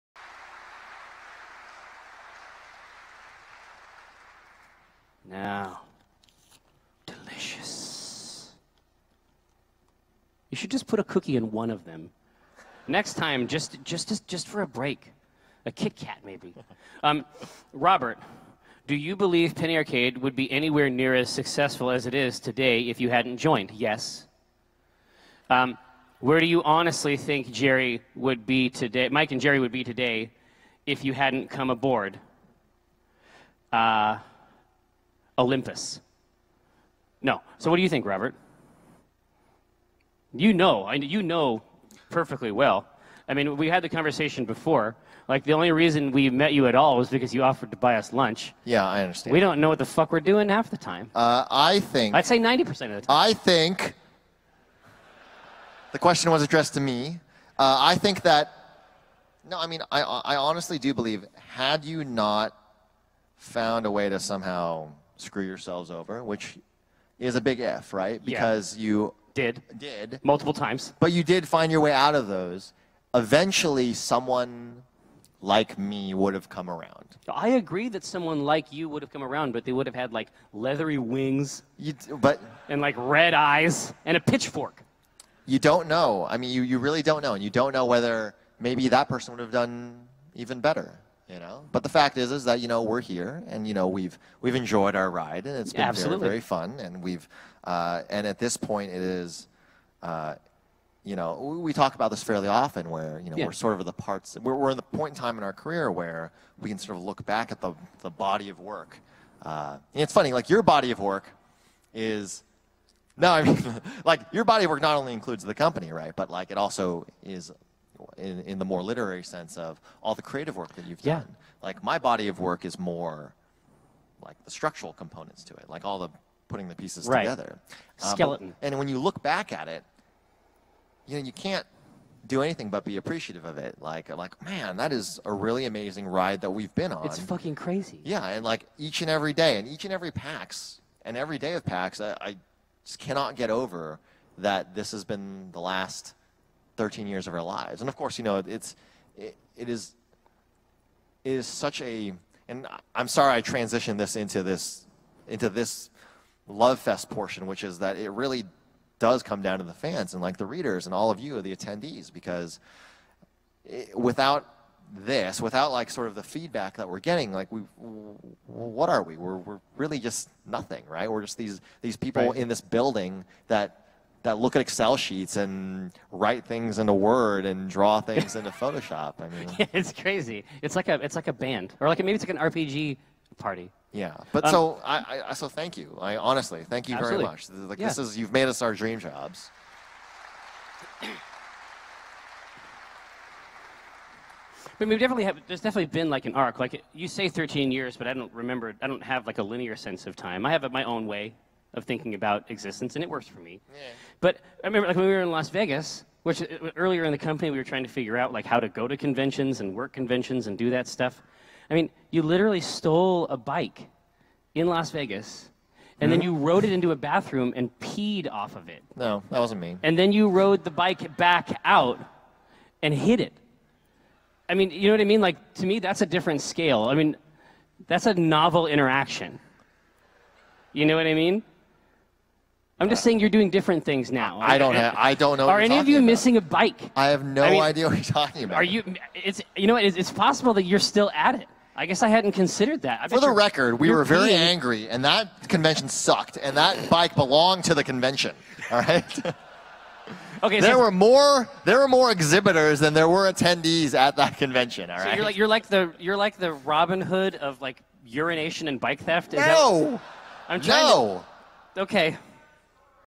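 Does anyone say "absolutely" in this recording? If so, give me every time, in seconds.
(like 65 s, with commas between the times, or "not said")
95 s, 186 s.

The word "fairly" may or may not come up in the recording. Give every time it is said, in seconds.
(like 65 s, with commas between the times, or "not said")
102 s.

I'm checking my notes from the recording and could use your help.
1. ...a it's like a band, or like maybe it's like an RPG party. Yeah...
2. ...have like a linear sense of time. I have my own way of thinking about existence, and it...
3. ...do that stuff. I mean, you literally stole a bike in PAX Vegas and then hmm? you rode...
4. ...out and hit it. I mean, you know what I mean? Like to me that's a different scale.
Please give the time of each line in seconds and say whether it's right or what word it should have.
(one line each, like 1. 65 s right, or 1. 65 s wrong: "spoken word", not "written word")
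1. 180 s right
2. 199 s right
3. 210 s wrong: "Las", not "PAX"
4. 221 s right.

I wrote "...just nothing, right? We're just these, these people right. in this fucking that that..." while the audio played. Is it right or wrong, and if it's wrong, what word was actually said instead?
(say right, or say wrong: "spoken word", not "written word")
wrong: "building", not "fucking".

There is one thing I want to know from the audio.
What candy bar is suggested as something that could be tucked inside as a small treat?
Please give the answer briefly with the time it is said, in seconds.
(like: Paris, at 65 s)
Kit Kat, at 15 s.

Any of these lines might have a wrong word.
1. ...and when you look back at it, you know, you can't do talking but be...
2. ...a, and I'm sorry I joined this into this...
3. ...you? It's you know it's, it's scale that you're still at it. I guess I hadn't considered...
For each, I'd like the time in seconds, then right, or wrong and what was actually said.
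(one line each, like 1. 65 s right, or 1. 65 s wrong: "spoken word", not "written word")
1. 128 s wrong: "anything", not "talking"
2. 151 s wrong: "transitioned", not "joined"
3. 238 s wrong: "possible", not "scale".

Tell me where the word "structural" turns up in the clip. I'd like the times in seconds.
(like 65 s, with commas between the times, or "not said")
124 s.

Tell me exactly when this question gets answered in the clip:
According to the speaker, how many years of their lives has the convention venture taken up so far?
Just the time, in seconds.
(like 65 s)
145 s.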